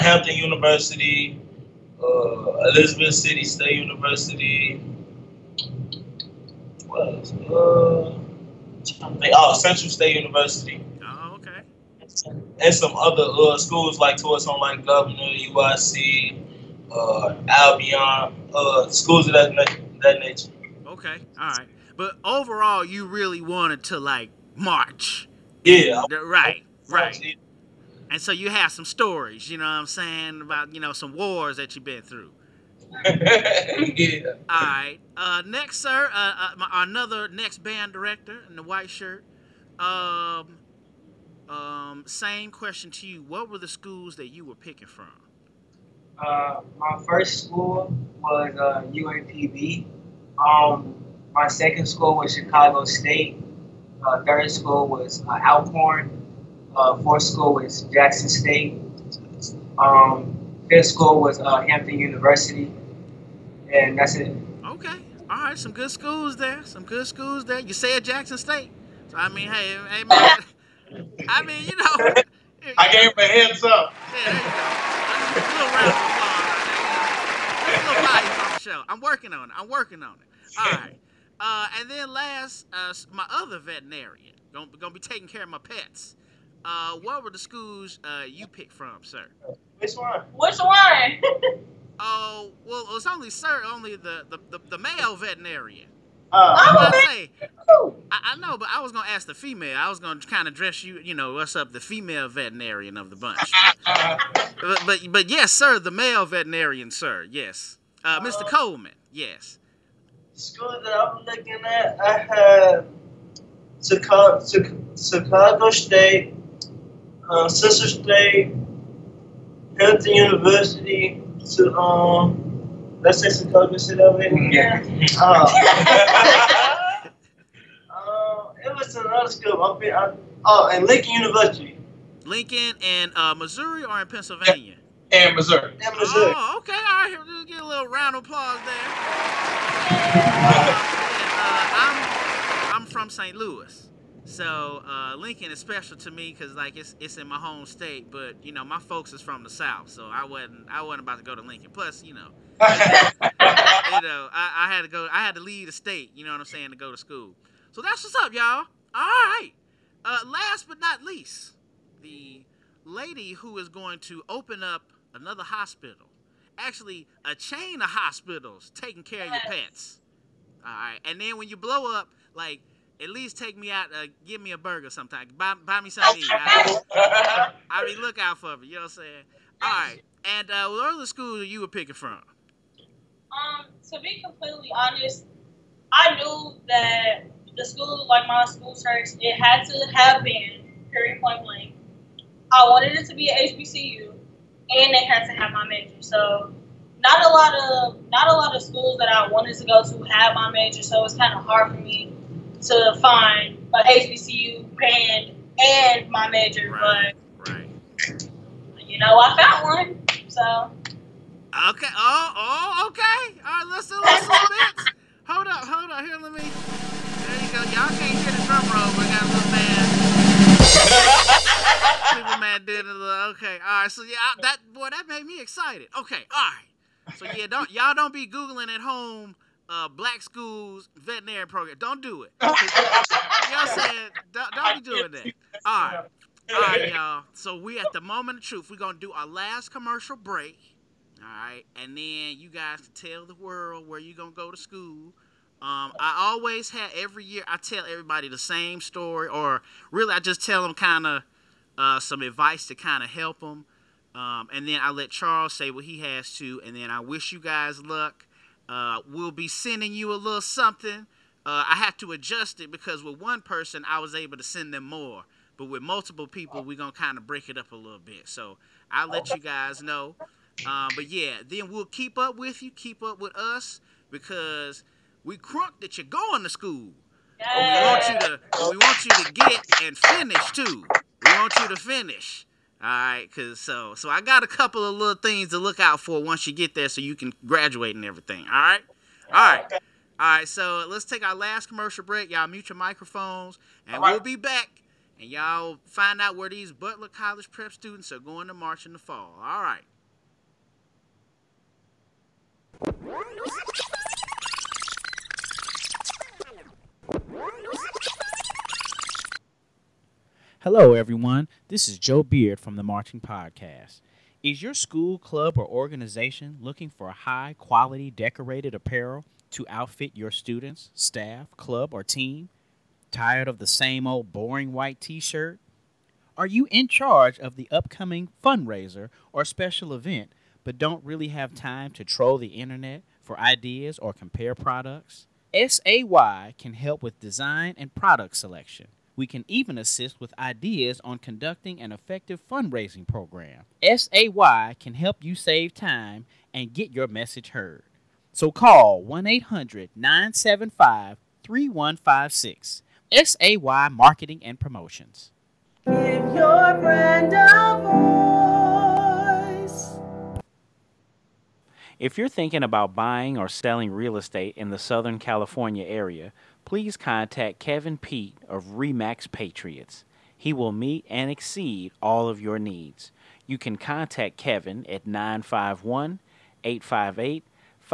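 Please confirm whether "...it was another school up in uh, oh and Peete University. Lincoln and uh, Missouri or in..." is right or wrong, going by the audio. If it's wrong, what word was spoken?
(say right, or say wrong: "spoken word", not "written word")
wrong: "Lincoln", not "Peete".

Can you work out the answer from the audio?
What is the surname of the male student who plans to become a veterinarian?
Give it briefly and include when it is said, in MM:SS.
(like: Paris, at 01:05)
Coleman, at 01:48.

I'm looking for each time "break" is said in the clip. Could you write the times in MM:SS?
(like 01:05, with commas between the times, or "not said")
04:00, 04:27, 04:52.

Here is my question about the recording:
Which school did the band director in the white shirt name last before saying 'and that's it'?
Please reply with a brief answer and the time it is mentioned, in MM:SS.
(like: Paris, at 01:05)
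Hampton University, at 01:01.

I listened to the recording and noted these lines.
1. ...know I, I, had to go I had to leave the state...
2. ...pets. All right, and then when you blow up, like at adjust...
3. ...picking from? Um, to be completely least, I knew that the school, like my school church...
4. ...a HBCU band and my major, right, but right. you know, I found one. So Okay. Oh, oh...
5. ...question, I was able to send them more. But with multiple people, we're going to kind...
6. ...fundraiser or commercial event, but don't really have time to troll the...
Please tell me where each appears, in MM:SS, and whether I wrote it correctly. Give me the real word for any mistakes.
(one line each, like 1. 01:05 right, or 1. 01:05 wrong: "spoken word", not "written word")
1. 02:32 right
2. 02:49 wrong: "least", not "adjust"
3. 03:01 wrong: "honest", not "least"
4. 03:23 right
5. 04:23 wrong: "person", not "question"
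6. 05:28 wrong: "special", not "commercial".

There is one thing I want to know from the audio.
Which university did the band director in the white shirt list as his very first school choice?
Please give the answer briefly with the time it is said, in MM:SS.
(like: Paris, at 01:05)
UAPB, at 00:48.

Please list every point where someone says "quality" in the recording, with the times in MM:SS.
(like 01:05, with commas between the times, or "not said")
05:17.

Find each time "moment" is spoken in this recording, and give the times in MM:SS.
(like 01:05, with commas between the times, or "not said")
03:58.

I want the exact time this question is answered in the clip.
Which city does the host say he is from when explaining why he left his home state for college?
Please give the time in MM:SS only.
02:23.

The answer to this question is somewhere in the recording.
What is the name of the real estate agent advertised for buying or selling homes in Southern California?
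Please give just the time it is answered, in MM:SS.
06:07.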